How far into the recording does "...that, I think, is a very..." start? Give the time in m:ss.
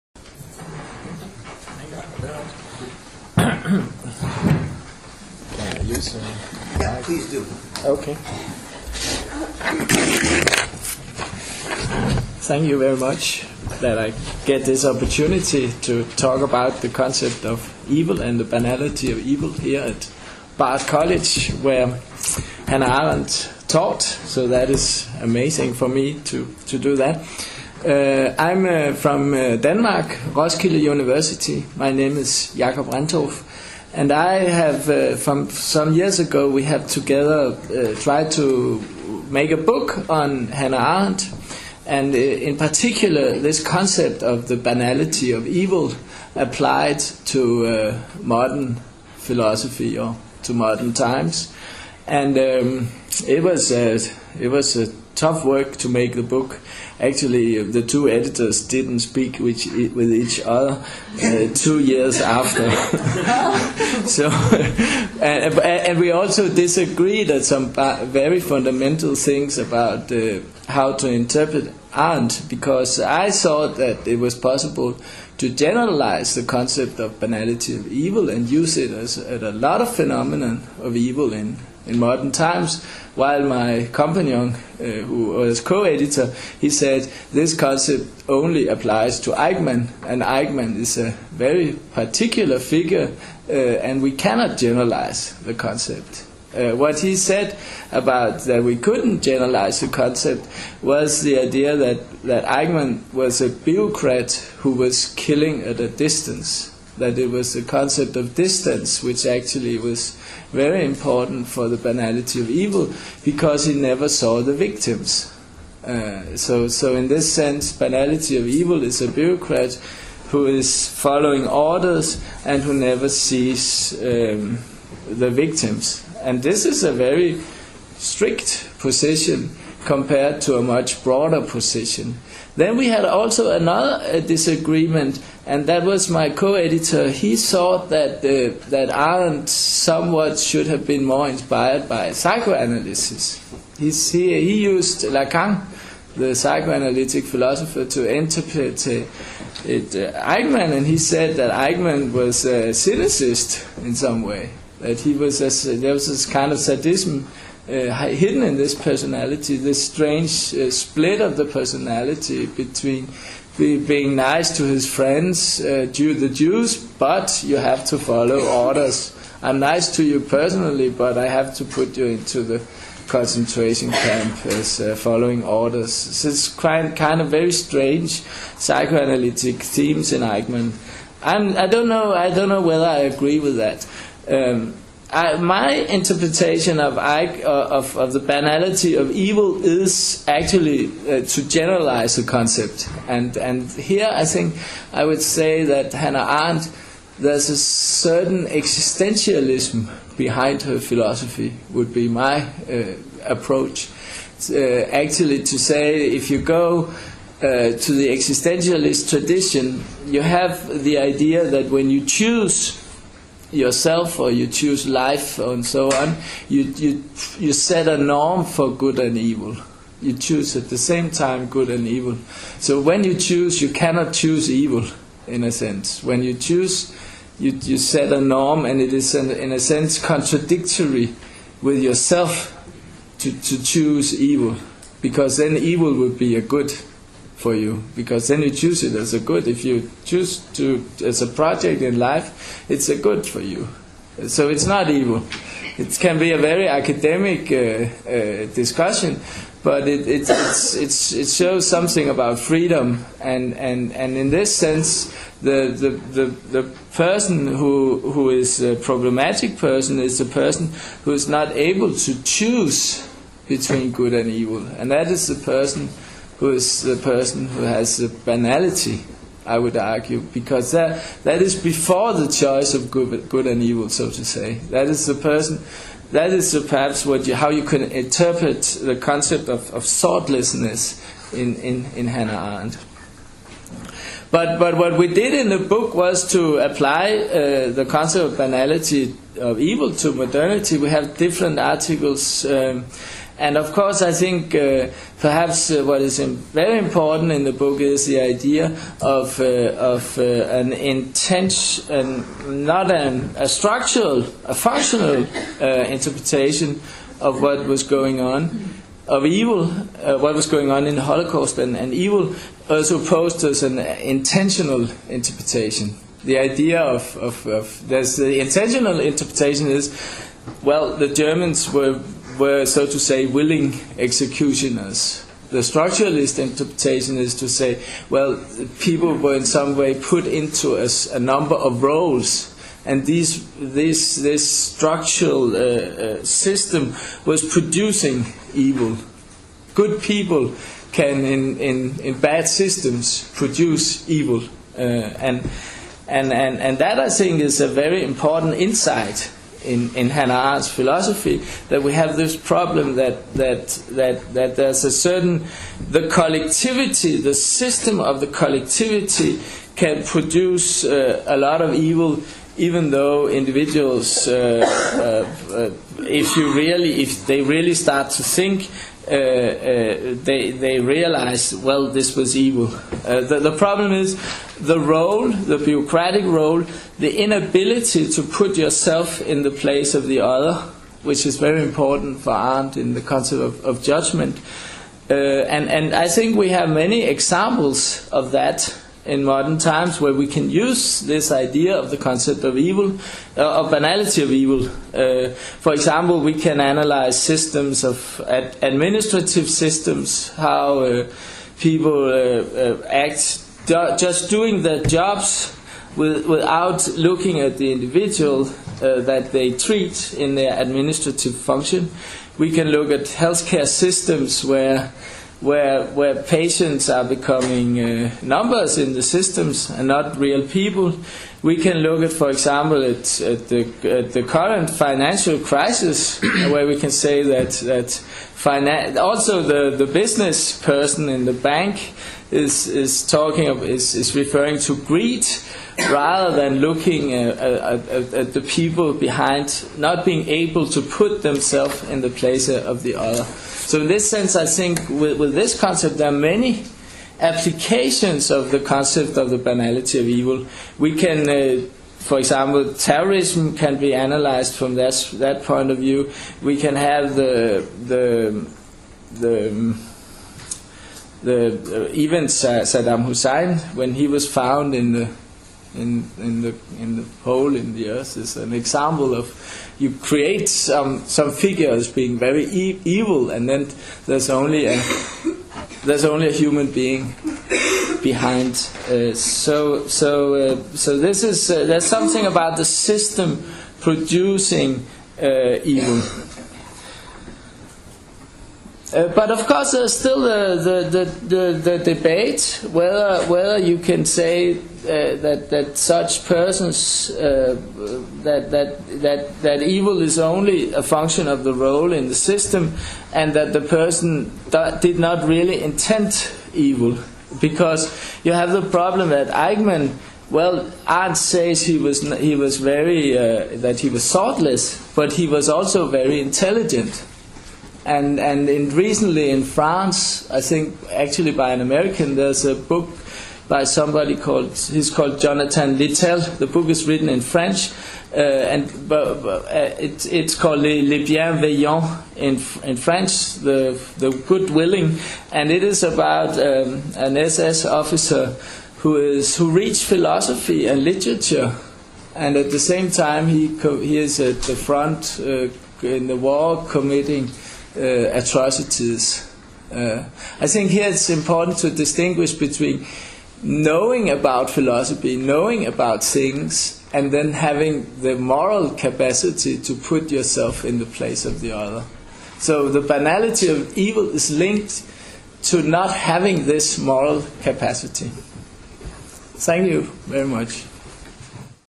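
5:46.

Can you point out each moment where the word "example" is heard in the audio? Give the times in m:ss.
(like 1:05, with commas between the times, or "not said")
6:27, 6:35, 7:02, 7:32, 7:48.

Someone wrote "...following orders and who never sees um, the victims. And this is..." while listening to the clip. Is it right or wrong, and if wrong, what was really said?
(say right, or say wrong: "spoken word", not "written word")
right.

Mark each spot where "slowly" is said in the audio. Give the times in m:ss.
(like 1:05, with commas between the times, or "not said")
not said.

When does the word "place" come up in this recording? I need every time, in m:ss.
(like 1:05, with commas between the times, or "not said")
6:19, 7:22, 9:20.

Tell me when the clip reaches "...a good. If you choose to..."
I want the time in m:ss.
3:59.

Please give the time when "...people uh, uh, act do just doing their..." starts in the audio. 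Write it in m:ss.
6:41.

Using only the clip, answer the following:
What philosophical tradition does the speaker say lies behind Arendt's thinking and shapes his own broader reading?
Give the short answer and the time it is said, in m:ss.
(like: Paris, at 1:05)
existentialism, at 3:18.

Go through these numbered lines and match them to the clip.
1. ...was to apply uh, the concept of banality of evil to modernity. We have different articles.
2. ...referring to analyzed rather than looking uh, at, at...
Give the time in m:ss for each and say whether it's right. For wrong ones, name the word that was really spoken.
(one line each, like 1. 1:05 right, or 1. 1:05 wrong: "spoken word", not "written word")
1. 4:45 right
2. 7:14 wrong: "greed", not "analyzed".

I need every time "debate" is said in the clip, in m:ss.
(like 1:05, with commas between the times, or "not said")
8:11.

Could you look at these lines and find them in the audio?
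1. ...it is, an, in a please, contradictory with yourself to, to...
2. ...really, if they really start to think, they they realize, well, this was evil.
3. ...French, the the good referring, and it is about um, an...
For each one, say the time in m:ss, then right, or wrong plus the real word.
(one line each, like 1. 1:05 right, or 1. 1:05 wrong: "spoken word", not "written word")
1. 3:48 wrong: "sense", not "please"
2. 6:06 right
3. 8:52 wrong: "willing", not "referring".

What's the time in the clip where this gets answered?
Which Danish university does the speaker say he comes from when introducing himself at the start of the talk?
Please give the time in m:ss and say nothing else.
0:30.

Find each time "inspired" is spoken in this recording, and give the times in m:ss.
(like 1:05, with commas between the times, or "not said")
2:21.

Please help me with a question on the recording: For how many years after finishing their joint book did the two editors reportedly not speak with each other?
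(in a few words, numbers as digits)
2.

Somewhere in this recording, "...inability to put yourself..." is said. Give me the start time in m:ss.
6:17.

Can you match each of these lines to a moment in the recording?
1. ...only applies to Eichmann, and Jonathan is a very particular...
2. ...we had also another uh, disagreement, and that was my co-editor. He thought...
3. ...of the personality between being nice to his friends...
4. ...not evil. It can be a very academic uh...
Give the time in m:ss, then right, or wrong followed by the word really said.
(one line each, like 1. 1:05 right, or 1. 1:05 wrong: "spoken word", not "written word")
1. 1:28 wrong: "Eichmann", not "Jonathan"
2. 2:12 right
3. 2:41 right
4. 4:04 right.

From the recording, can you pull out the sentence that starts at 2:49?
I'm nice to you personally, but I have to put you into the concentration camp as uh, following orders.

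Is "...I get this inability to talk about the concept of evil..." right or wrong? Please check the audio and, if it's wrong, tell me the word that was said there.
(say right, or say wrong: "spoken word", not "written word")
wrong: "opportunity", not "inability".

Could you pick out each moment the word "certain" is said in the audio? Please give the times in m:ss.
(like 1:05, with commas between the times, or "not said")
3:17, 5:54.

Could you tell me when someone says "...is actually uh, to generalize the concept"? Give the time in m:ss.
3:09.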